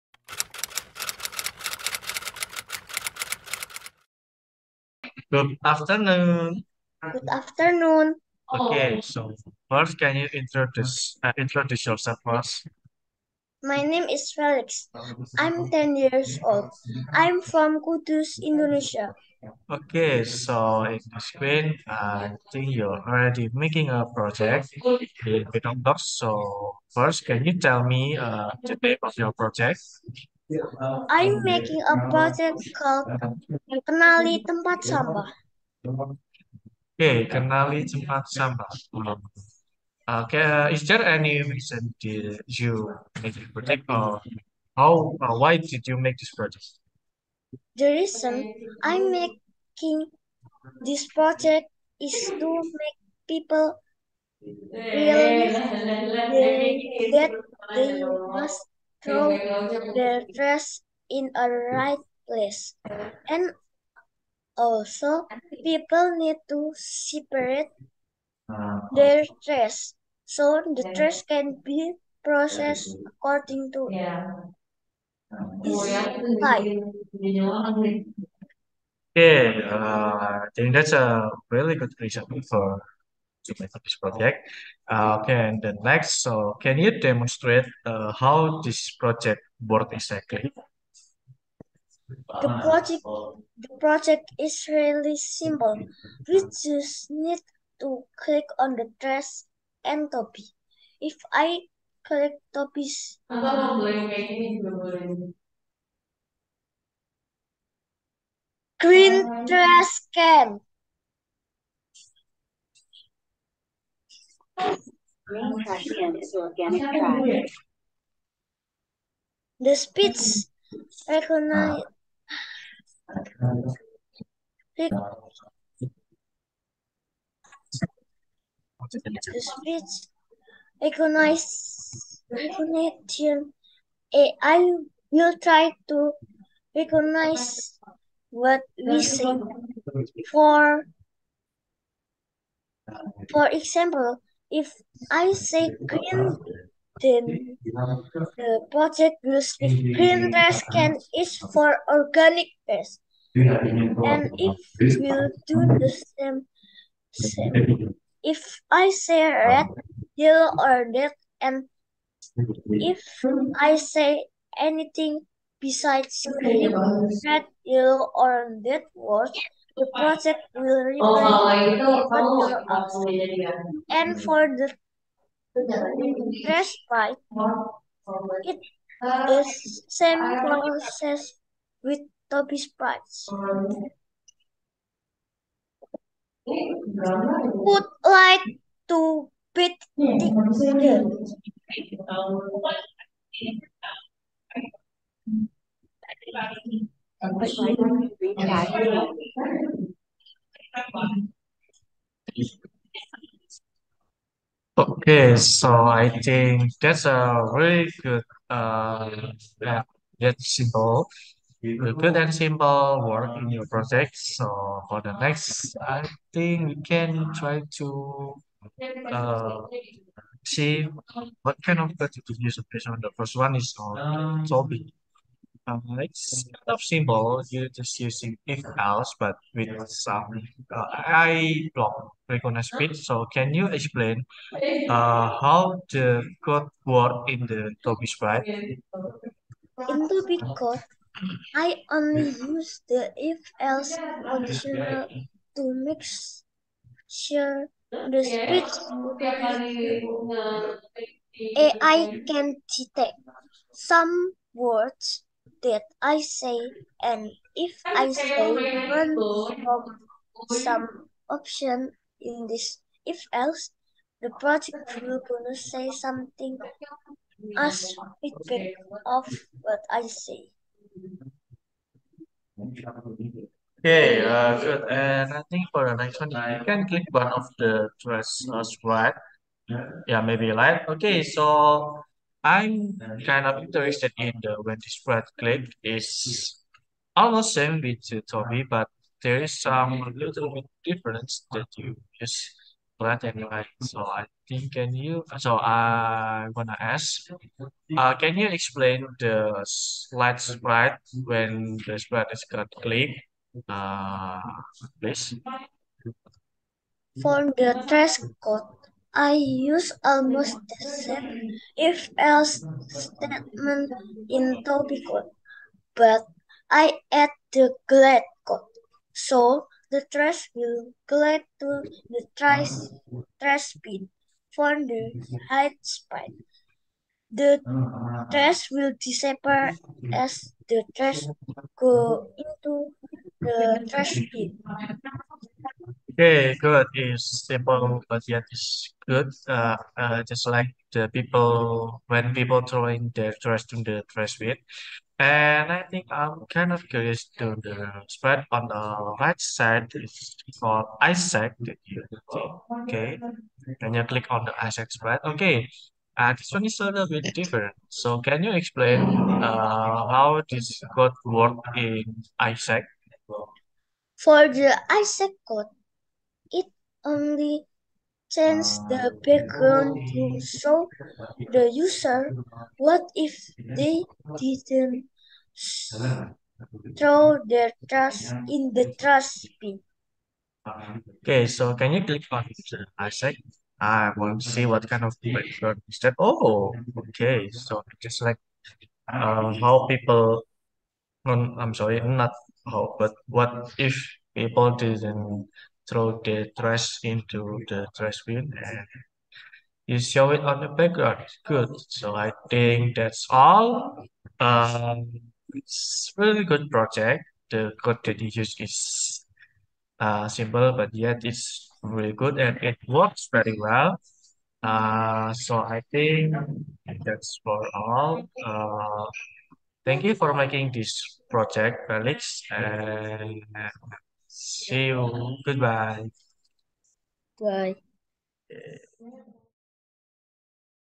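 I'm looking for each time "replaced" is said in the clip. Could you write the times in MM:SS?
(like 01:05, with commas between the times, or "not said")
not said.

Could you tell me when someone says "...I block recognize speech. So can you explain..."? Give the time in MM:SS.
03:50.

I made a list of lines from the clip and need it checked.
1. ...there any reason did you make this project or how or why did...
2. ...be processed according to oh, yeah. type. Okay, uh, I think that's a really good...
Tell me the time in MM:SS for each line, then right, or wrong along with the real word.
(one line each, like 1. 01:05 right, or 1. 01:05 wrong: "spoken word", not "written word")
1. 00:40 right
2. 01:11 right.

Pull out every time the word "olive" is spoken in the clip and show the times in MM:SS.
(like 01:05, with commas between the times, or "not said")
not said.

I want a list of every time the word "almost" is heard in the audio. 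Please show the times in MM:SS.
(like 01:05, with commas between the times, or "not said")
04:47, 05:10.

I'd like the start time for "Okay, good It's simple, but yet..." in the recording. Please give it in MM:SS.
05:36.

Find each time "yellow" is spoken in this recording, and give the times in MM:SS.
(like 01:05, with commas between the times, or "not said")
02:40, 02:47.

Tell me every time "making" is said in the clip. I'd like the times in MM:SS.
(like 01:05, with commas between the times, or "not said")
00:23, 00:31, 00:49, 07:00.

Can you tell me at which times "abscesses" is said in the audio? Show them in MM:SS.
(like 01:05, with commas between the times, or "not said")
not said.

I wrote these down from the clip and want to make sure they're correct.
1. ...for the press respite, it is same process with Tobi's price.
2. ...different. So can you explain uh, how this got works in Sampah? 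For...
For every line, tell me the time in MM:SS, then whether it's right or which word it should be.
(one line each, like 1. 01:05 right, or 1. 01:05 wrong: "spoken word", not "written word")
1. 02:54 right
2. 05:57 wrong: "Isaac", not "Sampah".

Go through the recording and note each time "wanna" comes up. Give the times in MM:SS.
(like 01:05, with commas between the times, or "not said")
04:56.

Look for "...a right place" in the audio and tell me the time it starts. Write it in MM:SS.
01:01.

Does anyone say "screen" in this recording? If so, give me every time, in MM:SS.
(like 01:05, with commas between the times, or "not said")
00:21.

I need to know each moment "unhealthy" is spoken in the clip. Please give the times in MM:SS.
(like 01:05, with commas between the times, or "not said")
not said.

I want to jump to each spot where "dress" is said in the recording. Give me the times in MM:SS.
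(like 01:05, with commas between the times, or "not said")
01:38, 01:49, 04:37.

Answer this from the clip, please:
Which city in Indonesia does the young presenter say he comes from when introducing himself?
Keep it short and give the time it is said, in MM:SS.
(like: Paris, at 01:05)
Kudus, at 00:17.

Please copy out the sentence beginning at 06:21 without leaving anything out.
Okay, so can you click on the uh, asset?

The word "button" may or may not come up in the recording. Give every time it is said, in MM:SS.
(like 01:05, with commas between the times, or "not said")
not said.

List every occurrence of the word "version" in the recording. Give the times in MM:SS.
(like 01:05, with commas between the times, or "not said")
not said.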